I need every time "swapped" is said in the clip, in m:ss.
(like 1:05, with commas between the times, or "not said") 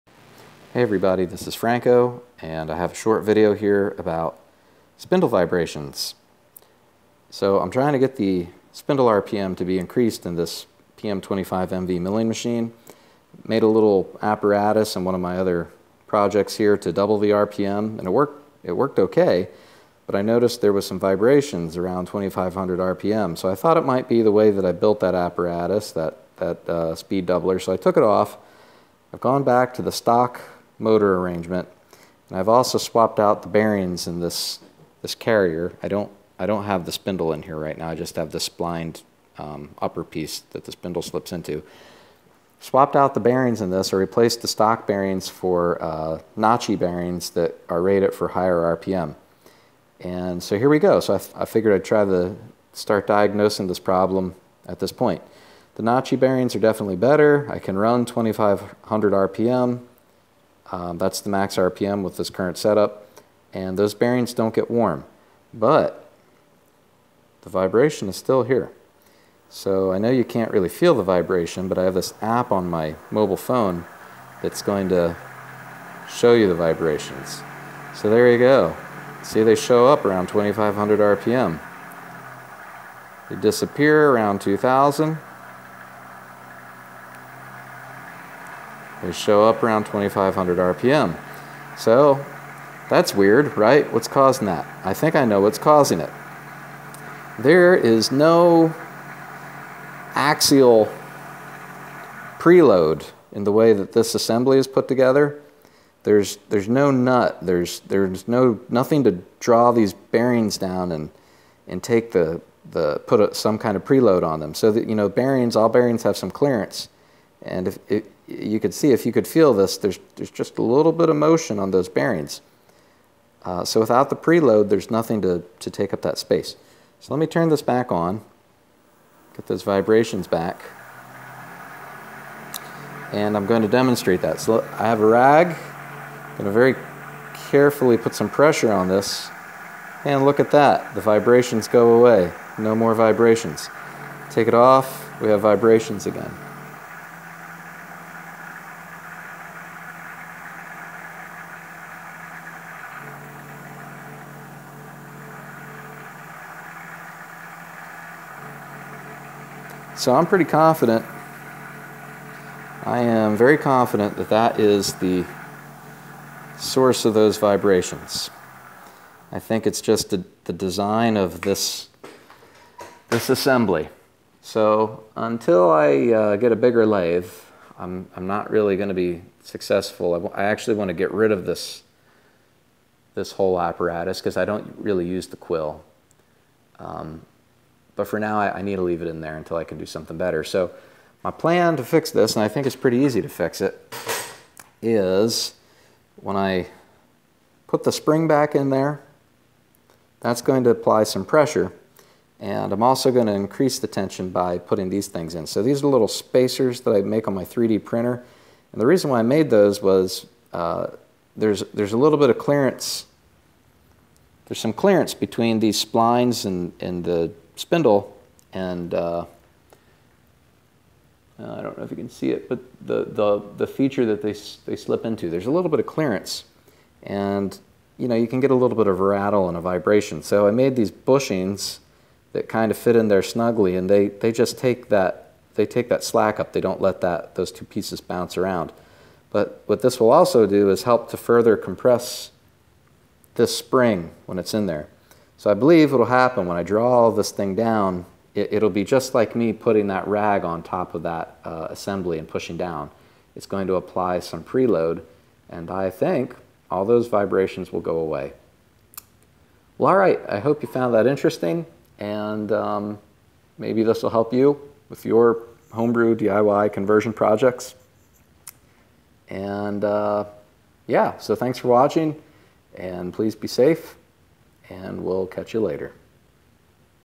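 0:32, 0:42.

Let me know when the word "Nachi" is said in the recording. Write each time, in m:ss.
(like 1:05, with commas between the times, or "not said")
0:46, 0:55.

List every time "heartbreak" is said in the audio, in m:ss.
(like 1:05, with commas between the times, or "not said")
not said.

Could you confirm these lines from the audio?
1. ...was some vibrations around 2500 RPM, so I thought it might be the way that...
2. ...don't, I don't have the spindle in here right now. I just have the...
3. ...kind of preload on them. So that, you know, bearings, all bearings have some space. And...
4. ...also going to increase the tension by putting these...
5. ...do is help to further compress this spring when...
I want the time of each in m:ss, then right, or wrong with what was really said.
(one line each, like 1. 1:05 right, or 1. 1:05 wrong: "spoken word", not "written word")
1. 0:20 right
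2. 0:35 right
3. 1:53 wrong: "clearance", not "space"
4. 3:22 right
5. 4:00 right.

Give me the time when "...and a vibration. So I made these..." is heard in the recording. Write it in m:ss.
3:49.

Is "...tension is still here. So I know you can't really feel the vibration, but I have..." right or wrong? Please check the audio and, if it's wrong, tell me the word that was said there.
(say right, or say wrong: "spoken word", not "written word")
wrong: "vibration", not "tension".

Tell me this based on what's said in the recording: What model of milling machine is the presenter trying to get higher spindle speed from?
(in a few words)
PM25MV.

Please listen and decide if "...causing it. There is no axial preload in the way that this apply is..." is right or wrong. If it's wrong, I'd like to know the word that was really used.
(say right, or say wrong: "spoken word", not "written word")
wrong: "assembly", not "apply".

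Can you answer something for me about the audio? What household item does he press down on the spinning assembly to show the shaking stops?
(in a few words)
A rag.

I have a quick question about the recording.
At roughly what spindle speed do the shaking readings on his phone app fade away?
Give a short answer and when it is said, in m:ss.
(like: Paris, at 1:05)
2000 RPM, at 1:24.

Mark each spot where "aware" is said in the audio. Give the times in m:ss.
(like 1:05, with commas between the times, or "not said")
not said.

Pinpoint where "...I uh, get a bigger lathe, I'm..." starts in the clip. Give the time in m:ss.
2:55.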